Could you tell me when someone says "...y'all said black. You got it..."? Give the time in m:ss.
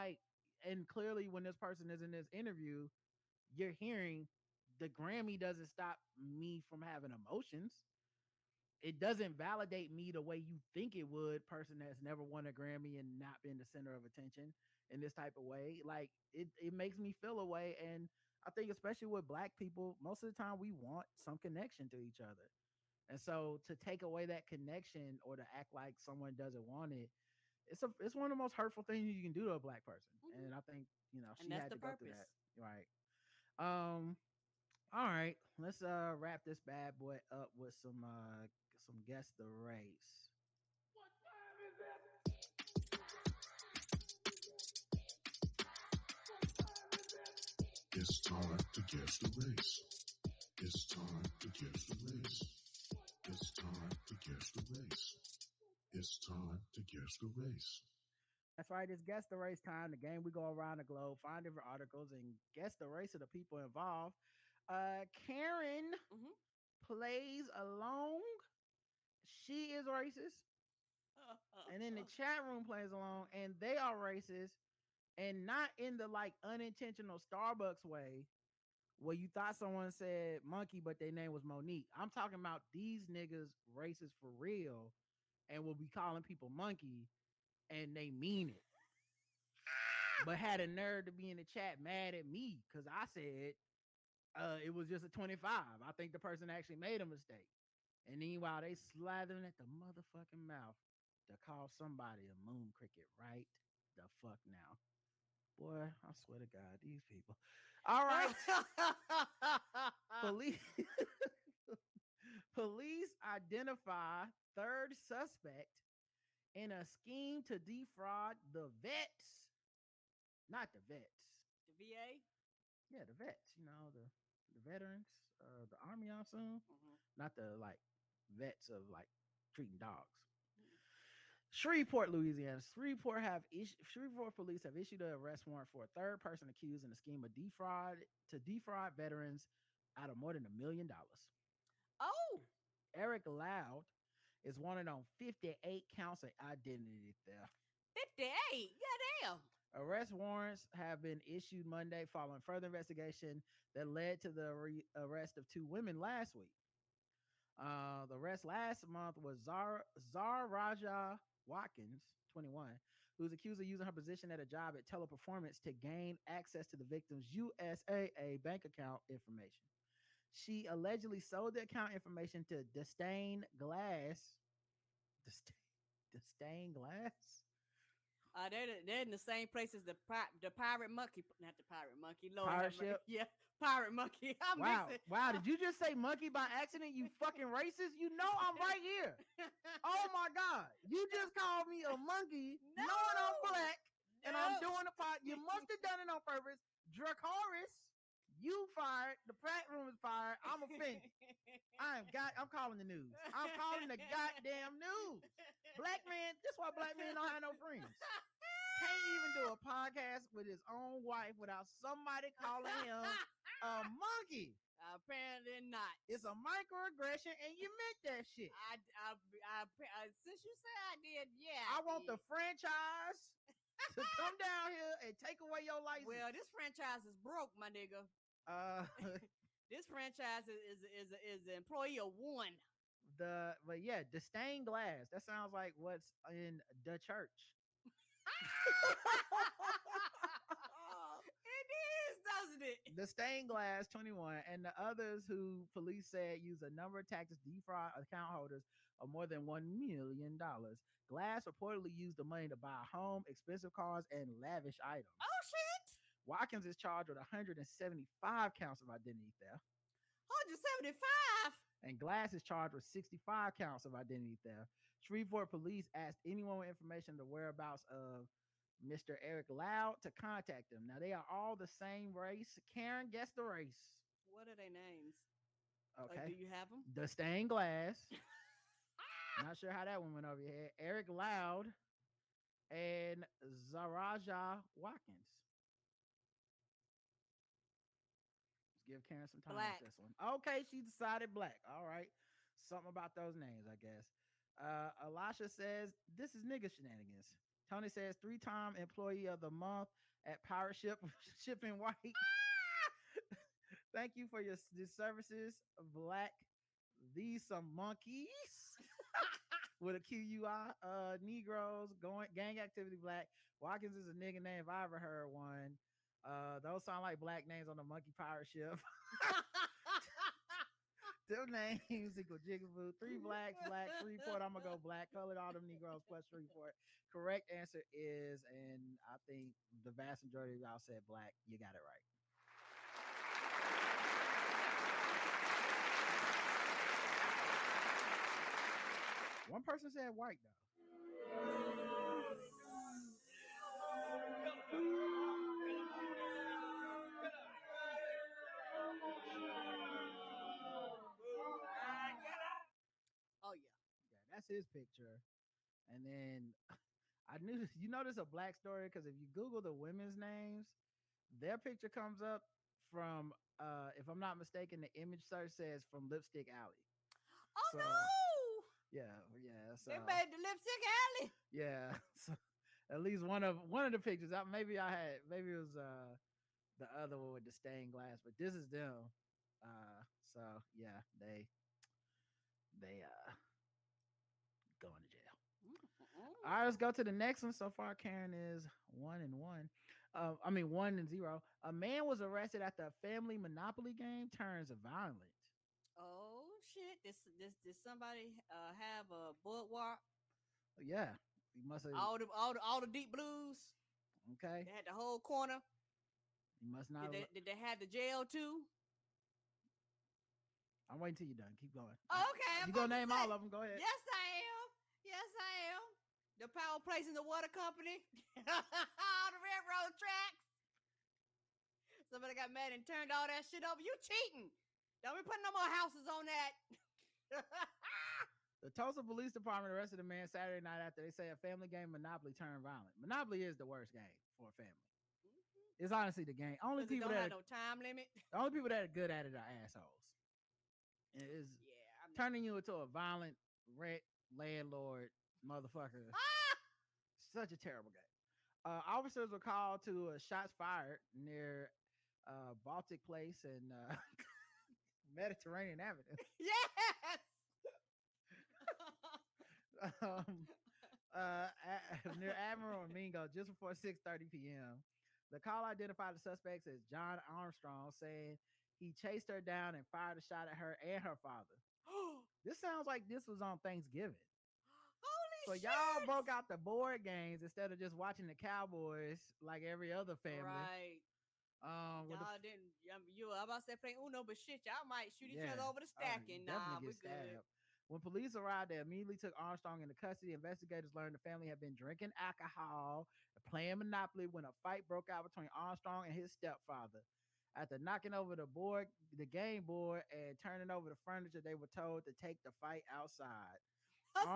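5:30.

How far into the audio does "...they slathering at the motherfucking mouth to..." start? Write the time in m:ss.
1:38.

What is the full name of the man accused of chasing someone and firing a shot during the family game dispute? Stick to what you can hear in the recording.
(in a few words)
John Armstrong.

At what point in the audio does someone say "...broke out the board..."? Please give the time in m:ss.
7:56.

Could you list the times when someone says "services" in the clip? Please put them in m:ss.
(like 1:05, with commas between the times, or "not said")
5:04.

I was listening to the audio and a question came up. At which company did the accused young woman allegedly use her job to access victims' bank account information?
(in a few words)
Teleperformance.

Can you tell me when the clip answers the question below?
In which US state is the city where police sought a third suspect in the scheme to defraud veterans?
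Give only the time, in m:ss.
2:12.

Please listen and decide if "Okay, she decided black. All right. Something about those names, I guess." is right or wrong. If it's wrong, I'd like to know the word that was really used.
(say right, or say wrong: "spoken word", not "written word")
right.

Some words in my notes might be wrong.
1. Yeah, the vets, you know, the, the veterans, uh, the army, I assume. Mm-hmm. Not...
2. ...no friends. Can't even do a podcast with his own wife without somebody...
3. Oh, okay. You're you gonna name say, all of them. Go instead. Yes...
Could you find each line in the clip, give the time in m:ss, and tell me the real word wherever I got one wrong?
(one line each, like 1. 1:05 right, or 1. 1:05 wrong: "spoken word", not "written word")
1. 2:02 right
2. 3:27 right
3. 6:52 wrong: "ahead", not "instead".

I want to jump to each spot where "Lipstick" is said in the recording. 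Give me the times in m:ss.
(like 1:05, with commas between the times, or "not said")
6:06, 6:10.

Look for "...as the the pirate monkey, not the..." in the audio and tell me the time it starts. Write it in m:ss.
2:59.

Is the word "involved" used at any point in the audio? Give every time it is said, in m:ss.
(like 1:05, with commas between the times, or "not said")
1:03.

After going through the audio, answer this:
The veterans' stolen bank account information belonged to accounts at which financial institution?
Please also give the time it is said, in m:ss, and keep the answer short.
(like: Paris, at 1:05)
USAA, at 2:47.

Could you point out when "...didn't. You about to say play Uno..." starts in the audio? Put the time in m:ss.
8:02.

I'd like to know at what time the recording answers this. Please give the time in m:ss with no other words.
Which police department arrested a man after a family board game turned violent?
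7:08.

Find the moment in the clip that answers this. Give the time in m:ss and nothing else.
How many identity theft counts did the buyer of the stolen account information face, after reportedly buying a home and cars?
4:22.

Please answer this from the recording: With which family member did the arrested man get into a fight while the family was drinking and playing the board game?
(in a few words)
His stepfather.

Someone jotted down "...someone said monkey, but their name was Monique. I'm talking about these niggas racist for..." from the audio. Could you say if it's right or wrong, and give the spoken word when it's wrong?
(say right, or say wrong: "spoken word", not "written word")
right.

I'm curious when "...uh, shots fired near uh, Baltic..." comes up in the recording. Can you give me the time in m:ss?
7:30.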